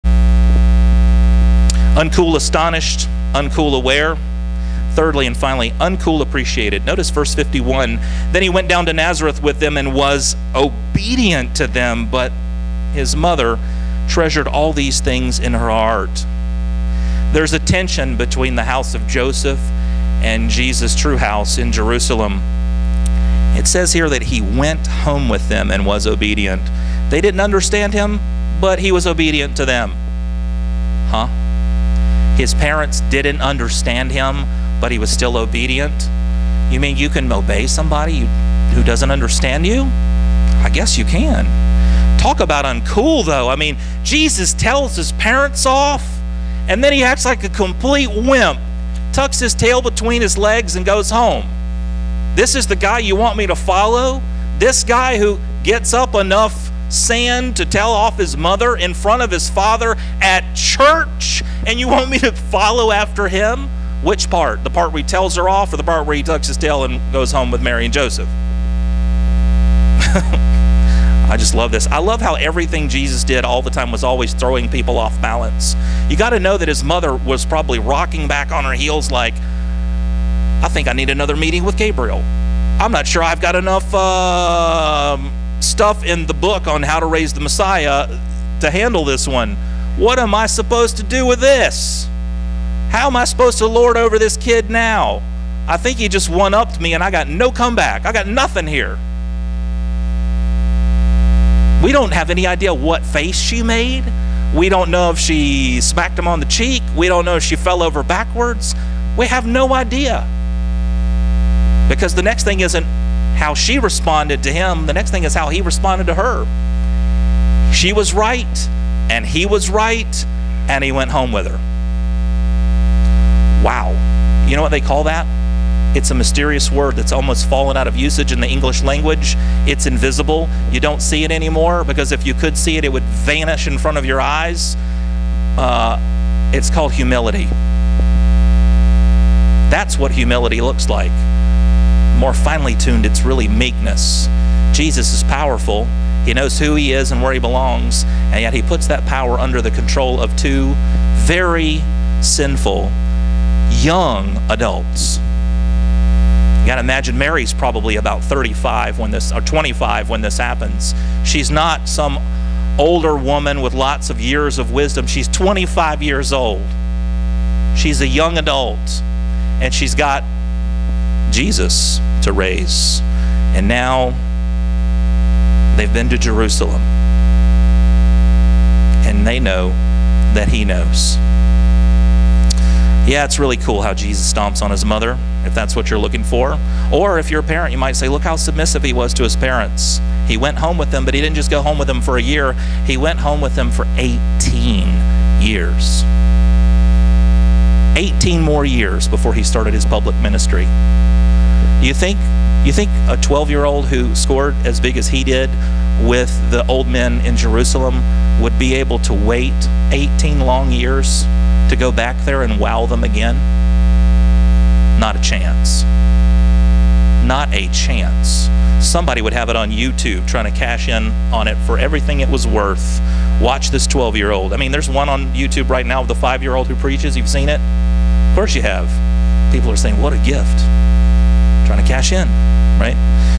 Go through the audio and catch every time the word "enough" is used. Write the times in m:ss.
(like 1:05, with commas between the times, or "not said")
0:56, 1:23.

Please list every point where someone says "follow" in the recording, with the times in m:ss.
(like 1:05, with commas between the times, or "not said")
0:53, 1:02.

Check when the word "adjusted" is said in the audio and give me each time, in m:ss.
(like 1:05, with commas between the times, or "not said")
not said.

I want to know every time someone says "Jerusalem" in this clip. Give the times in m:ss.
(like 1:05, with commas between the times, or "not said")
0:21, 2:56, 3:27.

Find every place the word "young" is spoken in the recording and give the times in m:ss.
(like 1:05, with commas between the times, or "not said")
2:33, 2:48.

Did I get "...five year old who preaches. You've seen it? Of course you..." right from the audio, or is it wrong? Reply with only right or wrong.
right.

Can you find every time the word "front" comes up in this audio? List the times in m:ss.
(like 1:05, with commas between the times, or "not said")
0:58, 2:13.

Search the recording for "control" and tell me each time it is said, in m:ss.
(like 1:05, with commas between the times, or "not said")
2:29.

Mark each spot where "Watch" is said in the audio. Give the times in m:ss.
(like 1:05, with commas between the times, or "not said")
3:43.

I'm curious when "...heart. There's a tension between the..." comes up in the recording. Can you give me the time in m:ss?
0:15.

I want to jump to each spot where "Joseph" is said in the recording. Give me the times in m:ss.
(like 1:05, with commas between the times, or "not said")
0:19, 1:07.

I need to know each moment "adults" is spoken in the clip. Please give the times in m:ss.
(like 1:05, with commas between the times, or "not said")
2:34, 2:48.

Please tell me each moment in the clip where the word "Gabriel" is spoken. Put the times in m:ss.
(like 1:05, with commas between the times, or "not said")
1:21.